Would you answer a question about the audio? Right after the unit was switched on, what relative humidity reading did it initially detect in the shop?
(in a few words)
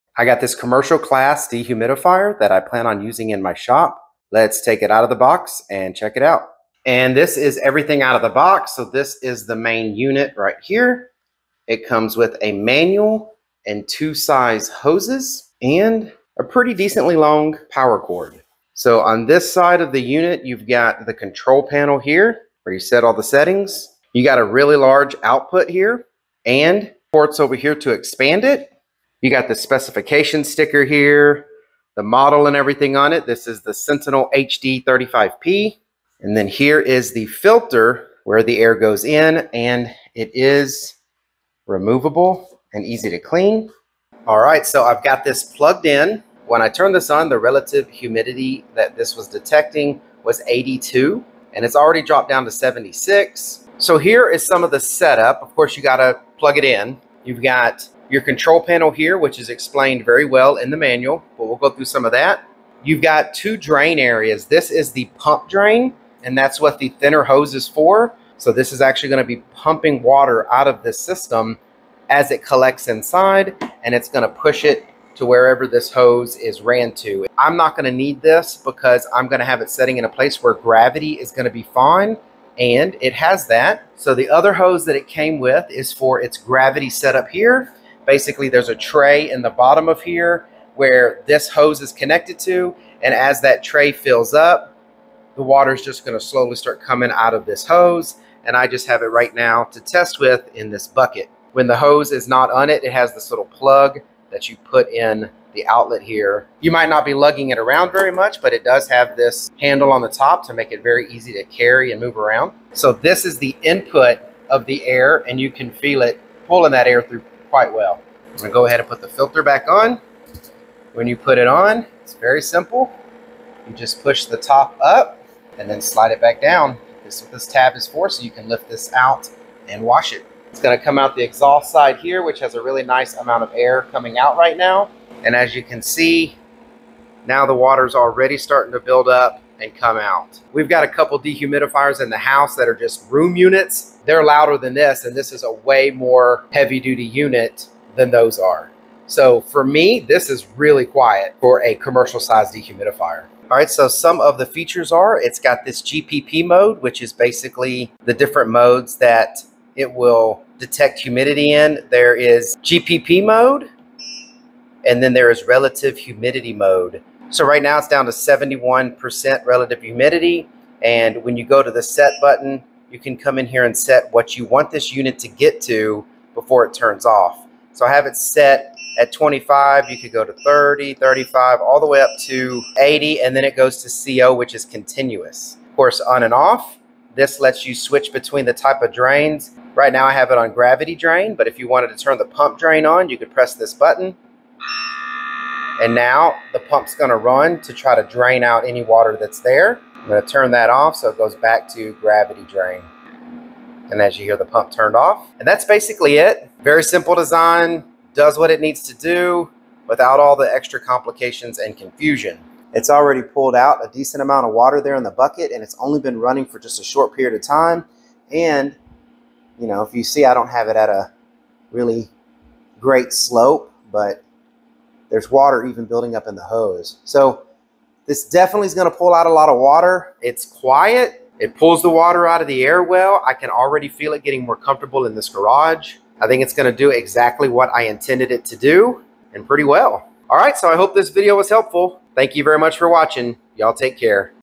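82.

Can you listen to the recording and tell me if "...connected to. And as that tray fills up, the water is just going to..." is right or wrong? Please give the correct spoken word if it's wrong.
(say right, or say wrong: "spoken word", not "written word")
right.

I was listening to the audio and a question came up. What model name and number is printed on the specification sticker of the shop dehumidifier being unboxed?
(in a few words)
Sentinel HD 35P.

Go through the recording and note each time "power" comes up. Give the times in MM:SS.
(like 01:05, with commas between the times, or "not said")
00:17.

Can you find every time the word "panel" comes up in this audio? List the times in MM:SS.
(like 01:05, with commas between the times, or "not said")
00:21, 00:58.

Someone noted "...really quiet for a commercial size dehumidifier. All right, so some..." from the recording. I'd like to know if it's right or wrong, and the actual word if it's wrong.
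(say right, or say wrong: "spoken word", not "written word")
right.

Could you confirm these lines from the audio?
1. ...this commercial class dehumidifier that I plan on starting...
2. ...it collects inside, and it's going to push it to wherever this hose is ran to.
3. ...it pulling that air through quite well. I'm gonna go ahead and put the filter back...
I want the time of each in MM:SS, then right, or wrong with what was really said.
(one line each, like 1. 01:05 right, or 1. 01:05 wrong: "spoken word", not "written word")
1. 00:00 wrong: "using", not "starting"
2. 01:12 right
3. 01:56 right.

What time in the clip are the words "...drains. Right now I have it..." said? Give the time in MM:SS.
03:08.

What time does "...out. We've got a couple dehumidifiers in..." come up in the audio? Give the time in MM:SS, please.
02:19.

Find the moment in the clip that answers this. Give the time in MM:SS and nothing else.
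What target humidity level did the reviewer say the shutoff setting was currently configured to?
02:59.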